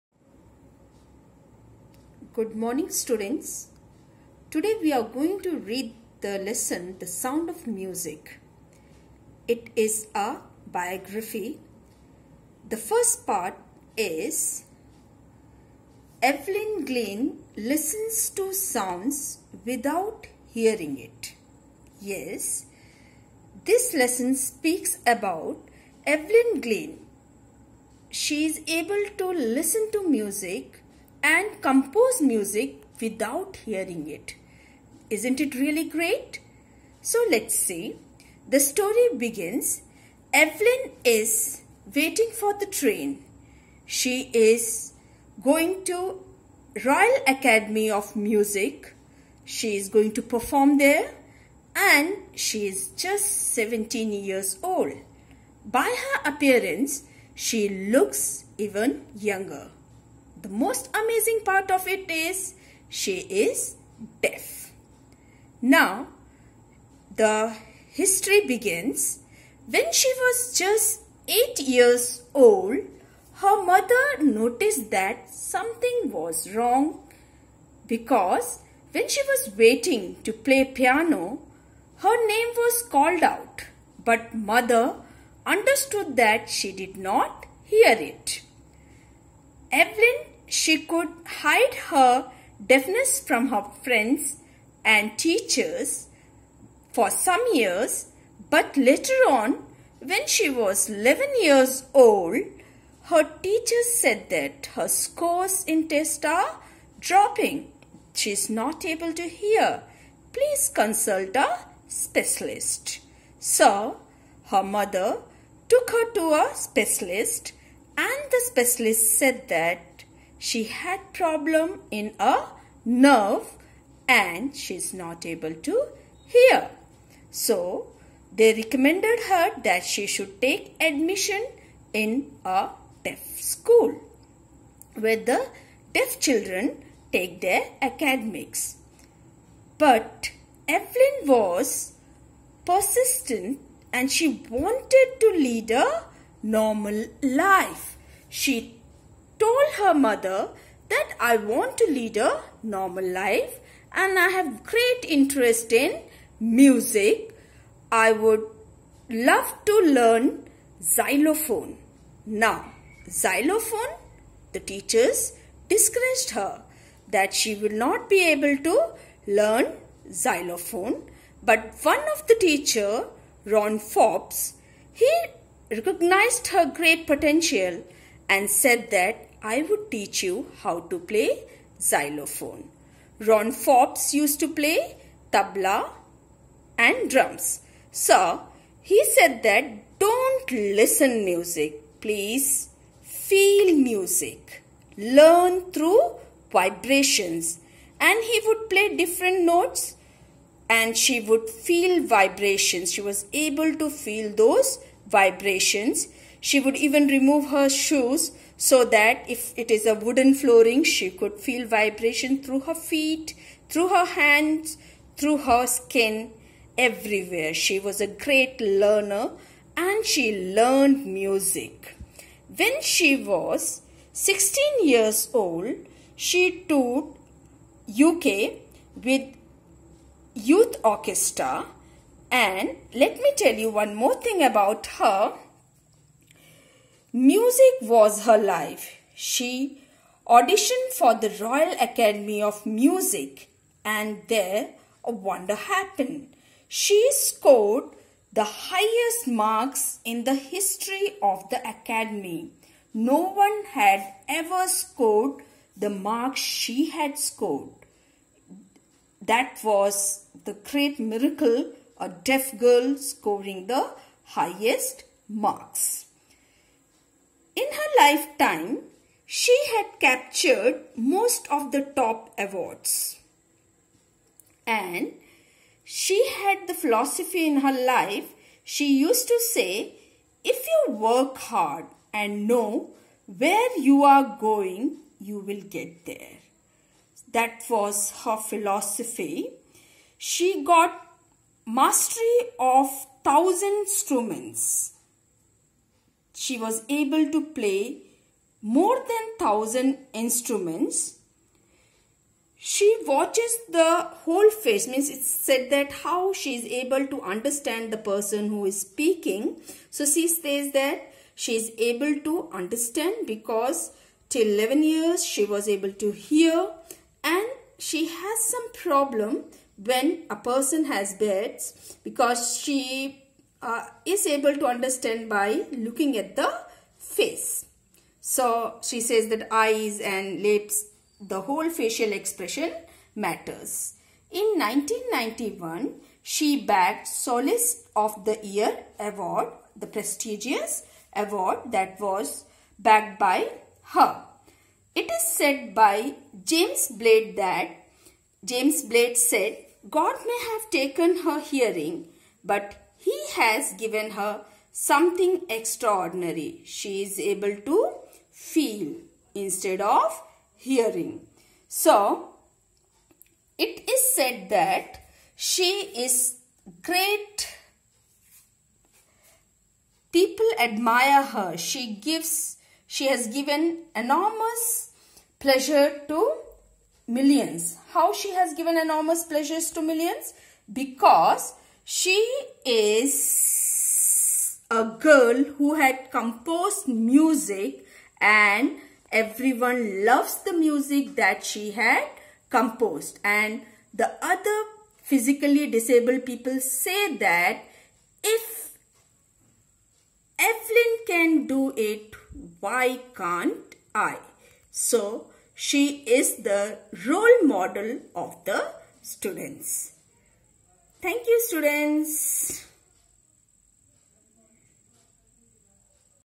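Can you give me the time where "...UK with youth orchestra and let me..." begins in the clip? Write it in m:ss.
3:48.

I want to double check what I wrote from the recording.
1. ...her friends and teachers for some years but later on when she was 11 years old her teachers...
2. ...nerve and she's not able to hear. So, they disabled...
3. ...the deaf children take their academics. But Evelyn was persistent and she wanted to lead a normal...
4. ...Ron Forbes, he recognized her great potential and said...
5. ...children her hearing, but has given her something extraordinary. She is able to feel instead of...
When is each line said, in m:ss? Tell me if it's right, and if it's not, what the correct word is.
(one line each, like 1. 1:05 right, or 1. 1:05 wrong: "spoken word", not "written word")
1. 1:33 right
2. 2:02 wrong: "recommended", not "disabled"
3. 2:15 right
4. 2:53 right
5. 5:50 wrong: "taken", not "children".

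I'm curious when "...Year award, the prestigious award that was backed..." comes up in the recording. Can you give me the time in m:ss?
5:38.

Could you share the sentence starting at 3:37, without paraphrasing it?
She was a great learner and she learned music.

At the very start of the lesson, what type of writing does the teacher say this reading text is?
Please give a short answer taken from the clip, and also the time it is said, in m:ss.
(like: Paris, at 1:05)
biography, at 0:10.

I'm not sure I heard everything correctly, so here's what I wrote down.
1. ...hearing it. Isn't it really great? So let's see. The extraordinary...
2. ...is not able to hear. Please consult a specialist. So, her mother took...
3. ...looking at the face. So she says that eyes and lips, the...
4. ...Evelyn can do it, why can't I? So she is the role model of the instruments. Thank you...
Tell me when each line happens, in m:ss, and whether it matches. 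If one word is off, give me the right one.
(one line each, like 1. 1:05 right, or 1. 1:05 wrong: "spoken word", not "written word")
1. 0:33 wrong: "story", not "extraordinary"
2. 1:48 right
3. 5:25 right
4. 6:40 wrong: "students", not "instruments".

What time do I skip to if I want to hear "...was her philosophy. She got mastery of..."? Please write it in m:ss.
4:47.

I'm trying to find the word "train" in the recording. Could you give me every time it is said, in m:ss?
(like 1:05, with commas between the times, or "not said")
0:42.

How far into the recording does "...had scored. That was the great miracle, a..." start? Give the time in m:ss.
4:16.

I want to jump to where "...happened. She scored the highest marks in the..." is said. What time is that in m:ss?
4:05.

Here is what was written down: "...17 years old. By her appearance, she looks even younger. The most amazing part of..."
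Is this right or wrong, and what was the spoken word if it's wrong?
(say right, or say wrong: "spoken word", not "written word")
right.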